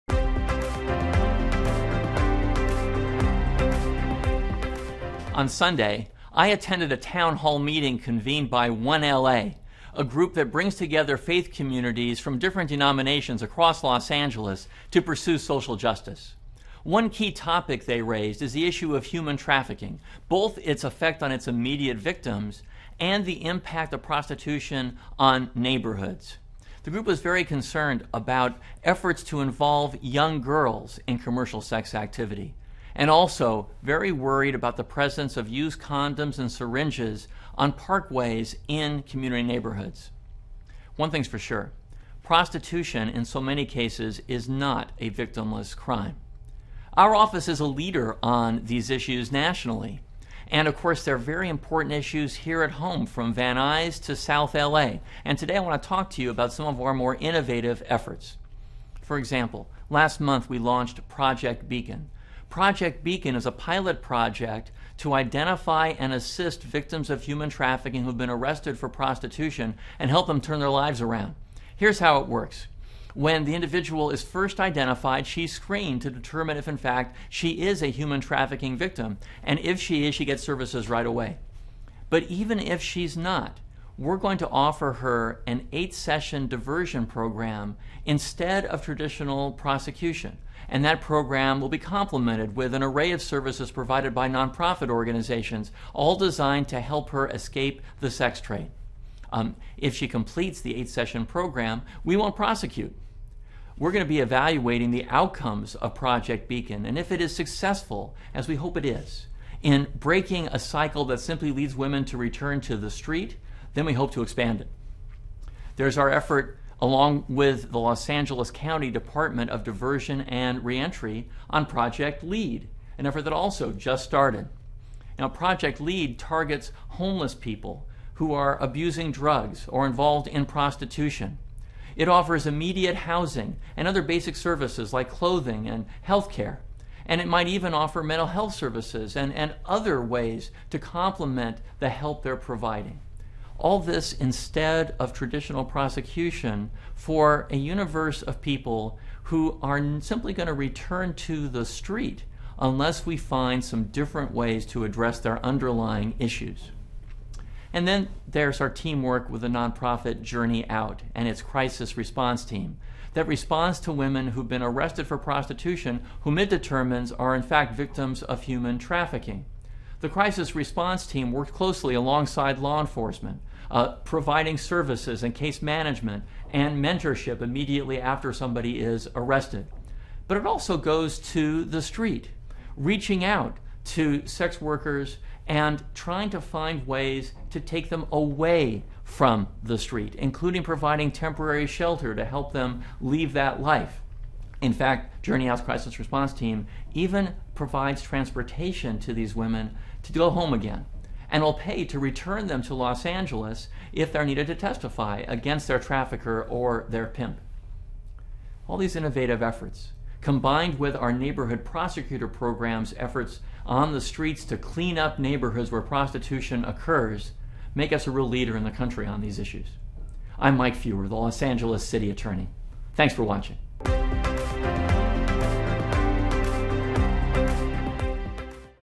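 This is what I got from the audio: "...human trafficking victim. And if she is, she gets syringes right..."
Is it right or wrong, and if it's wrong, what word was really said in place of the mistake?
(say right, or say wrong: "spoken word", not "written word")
wrong: "services", not "syringes".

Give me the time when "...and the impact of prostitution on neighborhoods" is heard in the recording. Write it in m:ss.
0:22.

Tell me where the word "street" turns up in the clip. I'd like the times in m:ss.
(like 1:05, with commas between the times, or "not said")
1:52, 2:31, 3:01, 3:09, 3:34.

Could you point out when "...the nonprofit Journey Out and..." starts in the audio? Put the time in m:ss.
2:39.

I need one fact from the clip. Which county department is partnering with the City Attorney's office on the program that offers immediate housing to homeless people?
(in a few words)
Department of Diversion and Reentry.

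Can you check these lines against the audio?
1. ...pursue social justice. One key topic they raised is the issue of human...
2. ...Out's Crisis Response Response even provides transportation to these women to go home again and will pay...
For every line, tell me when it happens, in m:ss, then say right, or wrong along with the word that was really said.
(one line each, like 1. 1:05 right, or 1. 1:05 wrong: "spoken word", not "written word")
1. 0:15 right
2. 3:15 wrong: "Team", not "Response".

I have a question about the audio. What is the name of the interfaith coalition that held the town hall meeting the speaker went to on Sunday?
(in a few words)
1LA.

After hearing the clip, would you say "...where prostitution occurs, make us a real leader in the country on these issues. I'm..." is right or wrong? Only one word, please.
right.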